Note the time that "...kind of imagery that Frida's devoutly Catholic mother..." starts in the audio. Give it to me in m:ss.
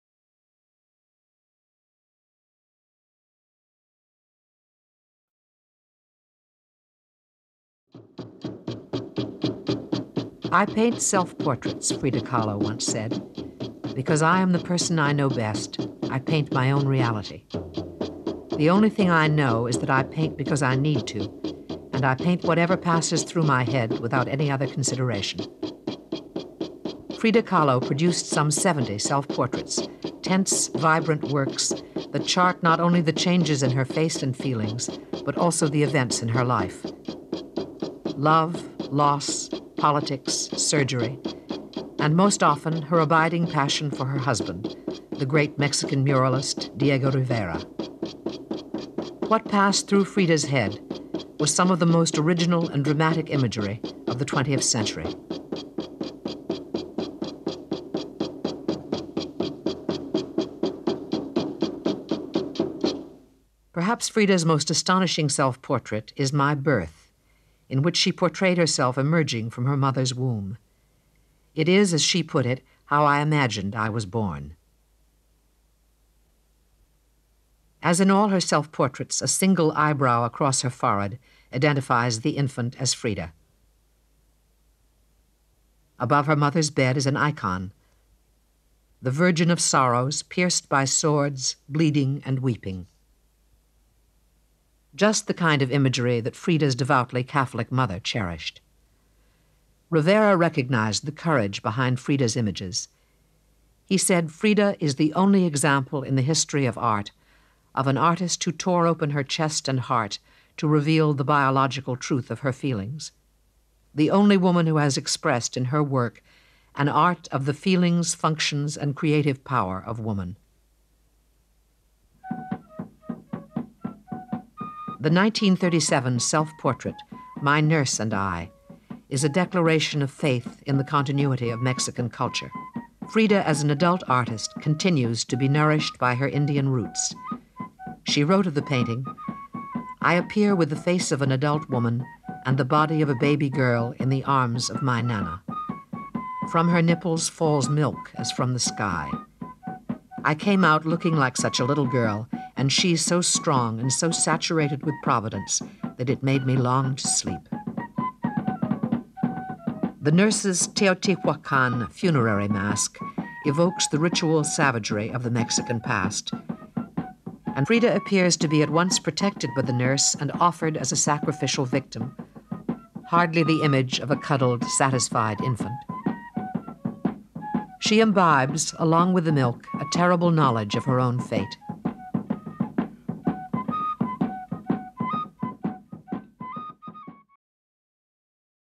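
1:35.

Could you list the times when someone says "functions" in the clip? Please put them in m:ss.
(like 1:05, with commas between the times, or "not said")
1:58.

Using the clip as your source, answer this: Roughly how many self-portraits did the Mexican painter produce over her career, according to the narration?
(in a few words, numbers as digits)
70.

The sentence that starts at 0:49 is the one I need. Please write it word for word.
What passed through Frida's head was some of the most original and dramatic imagery of the 20th century.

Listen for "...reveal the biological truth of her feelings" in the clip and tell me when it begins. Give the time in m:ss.
1:50.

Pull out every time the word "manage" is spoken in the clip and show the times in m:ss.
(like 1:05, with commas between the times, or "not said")
not said.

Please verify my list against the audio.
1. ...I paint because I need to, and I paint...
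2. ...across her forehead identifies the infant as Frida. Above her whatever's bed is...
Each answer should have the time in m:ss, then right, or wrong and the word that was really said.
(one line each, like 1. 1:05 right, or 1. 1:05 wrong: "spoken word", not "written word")
1. 0:19 right
2. 1:20 wrong: "mother", not "whatever".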